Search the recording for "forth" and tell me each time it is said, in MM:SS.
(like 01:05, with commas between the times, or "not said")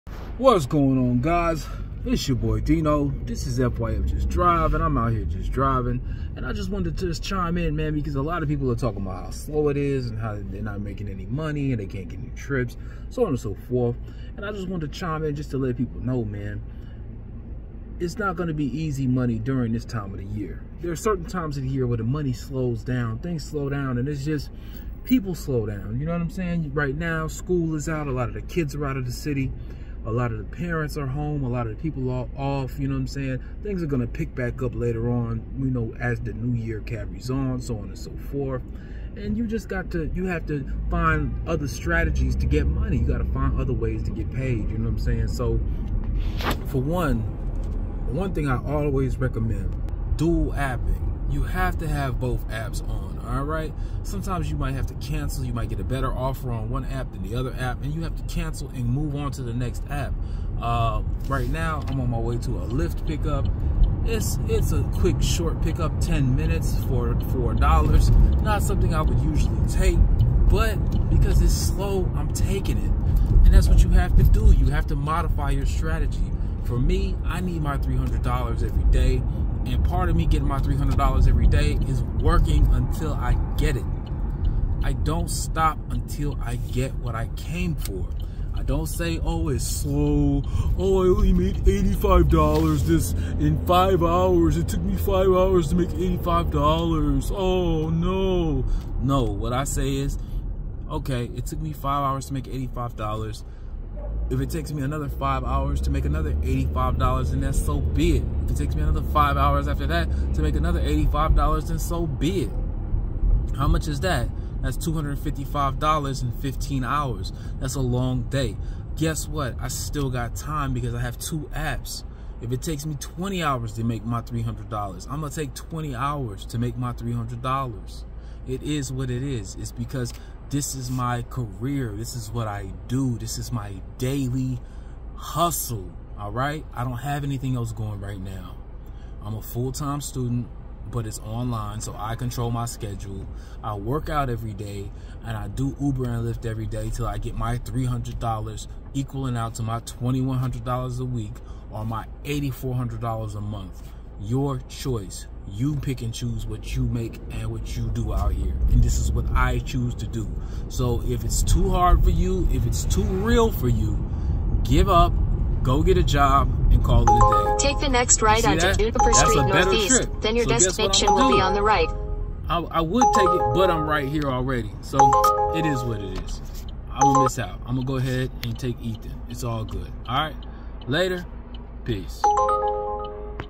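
00:13, 00:38.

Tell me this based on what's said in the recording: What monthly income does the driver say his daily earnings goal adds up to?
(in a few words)
$8,400.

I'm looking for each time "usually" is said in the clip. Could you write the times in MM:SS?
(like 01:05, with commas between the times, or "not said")
01:09.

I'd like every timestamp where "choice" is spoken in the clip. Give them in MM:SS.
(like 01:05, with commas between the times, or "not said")
02:34.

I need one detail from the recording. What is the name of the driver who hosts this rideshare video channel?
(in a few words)
Dino.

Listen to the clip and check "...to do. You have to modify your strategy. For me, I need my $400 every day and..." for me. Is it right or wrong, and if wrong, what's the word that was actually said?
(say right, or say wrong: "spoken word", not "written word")
wrong: "300", not "400".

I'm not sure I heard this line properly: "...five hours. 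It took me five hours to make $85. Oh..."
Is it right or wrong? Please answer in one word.
right.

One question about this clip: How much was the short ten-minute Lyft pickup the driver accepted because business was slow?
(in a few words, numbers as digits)
$4.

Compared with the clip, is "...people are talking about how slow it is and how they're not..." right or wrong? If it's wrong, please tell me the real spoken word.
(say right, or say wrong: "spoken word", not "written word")
right.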